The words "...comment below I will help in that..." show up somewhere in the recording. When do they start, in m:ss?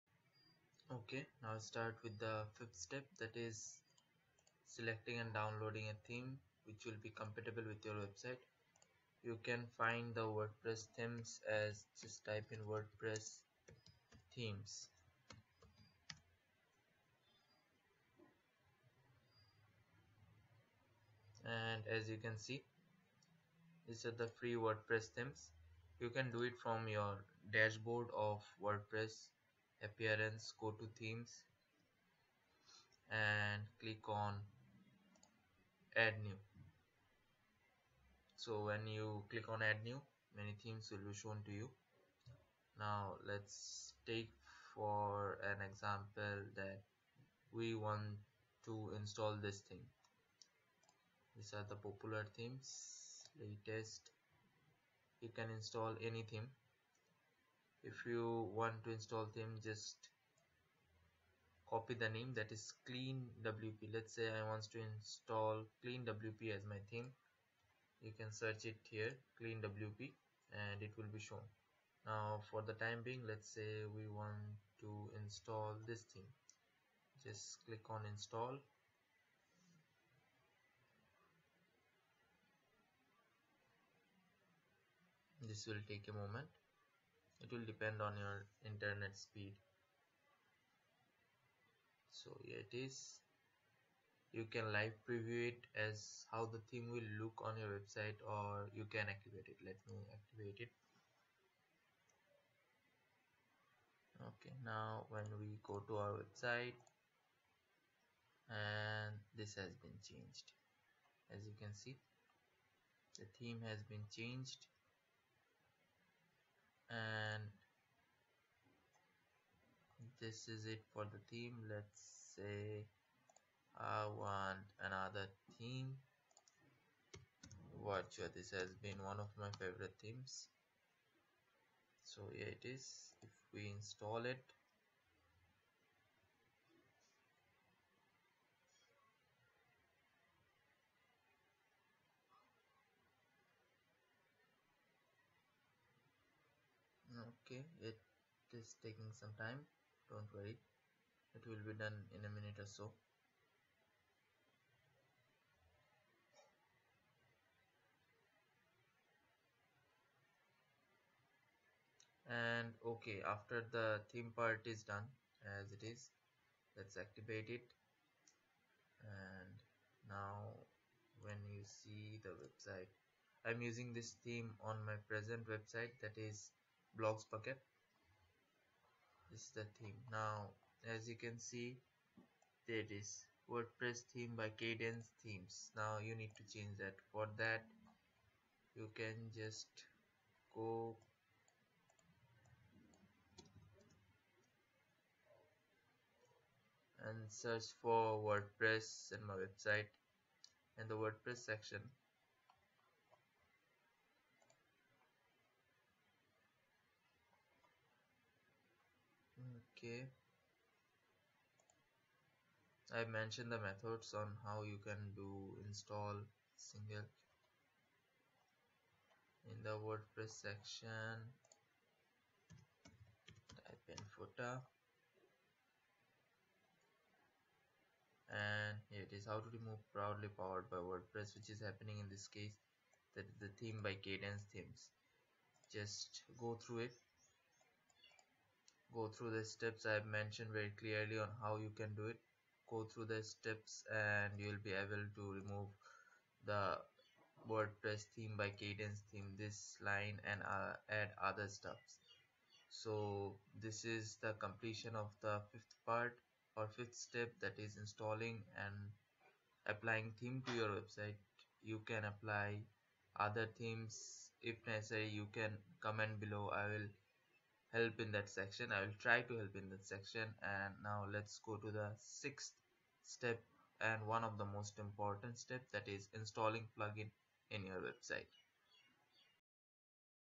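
4:25.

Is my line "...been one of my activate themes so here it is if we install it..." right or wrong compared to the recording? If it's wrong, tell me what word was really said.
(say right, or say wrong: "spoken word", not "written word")
wrong: "favorite", not "activate".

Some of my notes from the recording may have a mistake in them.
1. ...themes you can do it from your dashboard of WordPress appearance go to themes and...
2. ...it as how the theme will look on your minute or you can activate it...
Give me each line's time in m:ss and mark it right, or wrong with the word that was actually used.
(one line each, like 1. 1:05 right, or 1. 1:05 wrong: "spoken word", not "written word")
1. 0:25 right
2. 1:35 wrong: "website", not "minute".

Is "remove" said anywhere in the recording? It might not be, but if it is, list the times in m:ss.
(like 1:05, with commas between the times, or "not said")
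3:49, 4:05.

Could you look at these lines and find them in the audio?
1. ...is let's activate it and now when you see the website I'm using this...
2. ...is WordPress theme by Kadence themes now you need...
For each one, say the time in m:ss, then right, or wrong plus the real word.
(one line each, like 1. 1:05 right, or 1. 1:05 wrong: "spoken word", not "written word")
1. 2:45 right
2. 3:02 right.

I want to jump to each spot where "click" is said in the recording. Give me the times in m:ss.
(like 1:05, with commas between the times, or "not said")
0:33, 0:39, 1:17.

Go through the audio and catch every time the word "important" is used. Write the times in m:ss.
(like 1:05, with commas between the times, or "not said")
4:34.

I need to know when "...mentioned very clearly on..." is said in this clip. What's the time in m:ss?
4:00.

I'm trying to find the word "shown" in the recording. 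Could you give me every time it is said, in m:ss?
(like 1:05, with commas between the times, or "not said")
0:41, 1:11.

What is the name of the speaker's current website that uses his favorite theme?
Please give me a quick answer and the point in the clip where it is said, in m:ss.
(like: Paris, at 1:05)
Blogsbucket, at 2:56.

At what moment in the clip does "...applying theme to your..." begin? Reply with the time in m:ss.
4:19.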